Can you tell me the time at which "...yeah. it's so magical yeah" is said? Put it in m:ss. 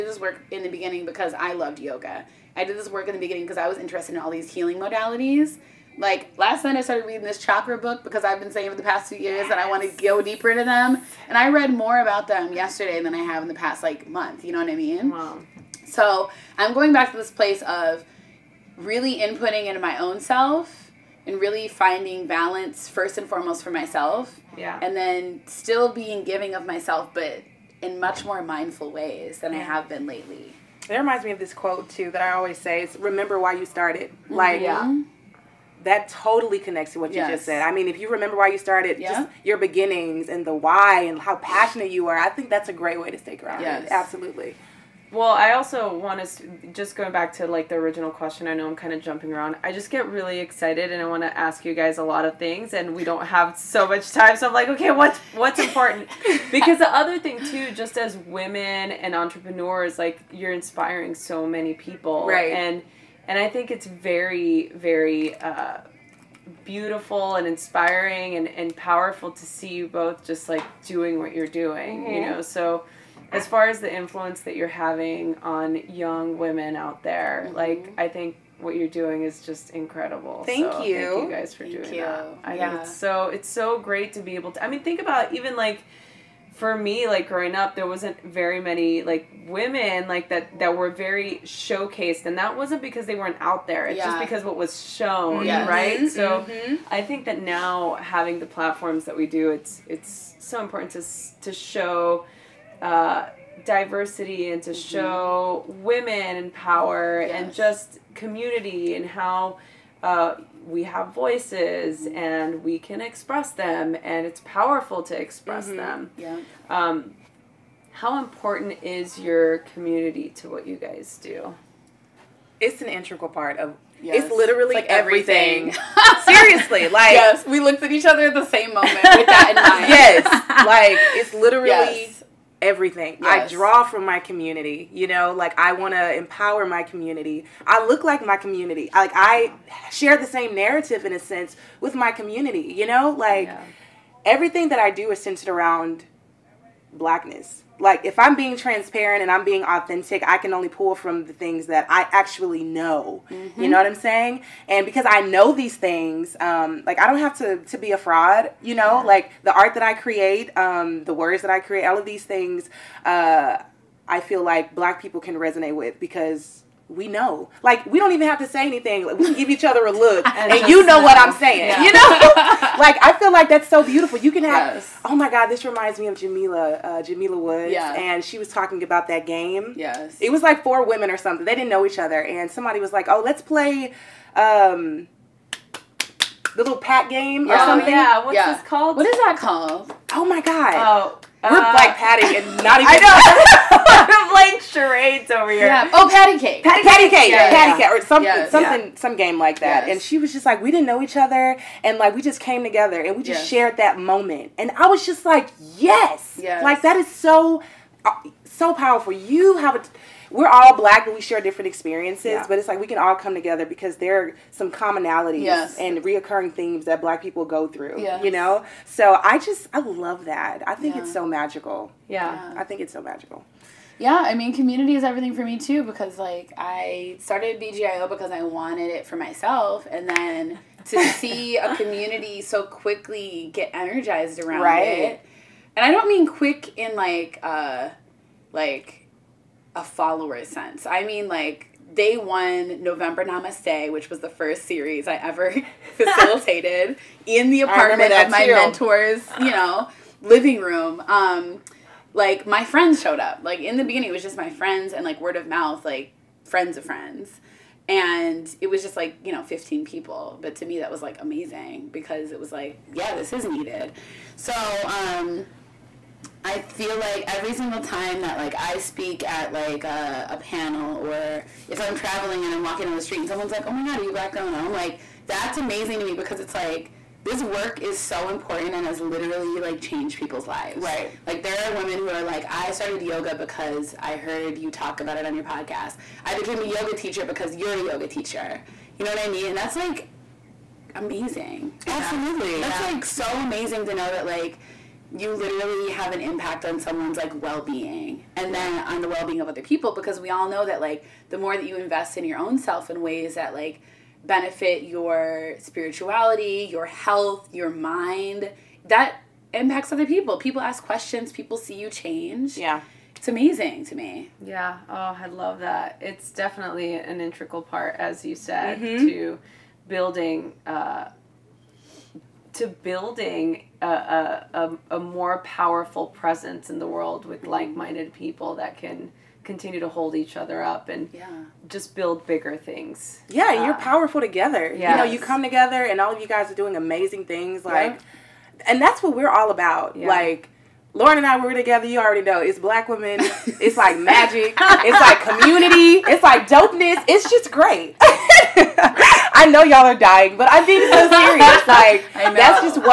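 3:40.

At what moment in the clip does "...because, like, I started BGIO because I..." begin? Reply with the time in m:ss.
3:45.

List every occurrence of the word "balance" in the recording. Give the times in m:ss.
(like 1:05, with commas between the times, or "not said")
0:22.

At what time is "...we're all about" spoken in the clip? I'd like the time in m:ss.
5:39.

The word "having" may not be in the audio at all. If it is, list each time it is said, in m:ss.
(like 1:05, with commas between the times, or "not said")
1:14, 1:37.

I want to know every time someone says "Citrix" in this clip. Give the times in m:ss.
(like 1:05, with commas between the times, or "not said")
not said.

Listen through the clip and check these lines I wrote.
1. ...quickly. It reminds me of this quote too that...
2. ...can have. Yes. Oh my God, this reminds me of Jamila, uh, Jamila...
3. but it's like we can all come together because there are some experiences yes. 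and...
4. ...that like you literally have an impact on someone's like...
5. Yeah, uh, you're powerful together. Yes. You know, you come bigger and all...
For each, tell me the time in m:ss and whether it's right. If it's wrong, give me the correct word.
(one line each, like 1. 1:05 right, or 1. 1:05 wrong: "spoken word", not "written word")
1. 0:30 wrong: "lately", not "quickly"
2. 2:54 right
3. 3:32 wrong: "commonalities", not "experiences"
4. 4:54 right
5. 5:33 wrong: "together", not "bigger".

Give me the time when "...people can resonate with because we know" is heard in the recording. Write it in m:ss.
2:45.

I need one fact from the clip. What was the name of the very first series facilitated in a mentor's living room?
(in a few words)
November Namaste.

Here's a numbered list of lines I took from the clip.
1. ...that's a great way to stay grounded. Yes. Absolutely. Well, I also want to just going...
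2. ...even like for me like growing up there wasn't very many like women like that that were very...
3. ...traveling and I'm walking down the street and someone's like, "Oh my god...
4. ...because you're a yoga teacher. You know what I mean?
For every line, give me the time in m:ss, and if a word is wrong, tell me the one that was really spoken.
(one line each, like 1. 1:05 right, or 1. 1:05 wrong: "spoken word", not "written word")
1. 0:42 right
2. 1:25 right
3. 4:31 right
4. 4:47 right.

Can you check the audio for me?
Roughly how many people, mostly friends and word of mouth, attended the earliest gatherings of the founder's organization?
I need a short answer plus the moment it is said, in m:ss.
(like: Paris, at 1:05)
15, at 4:19.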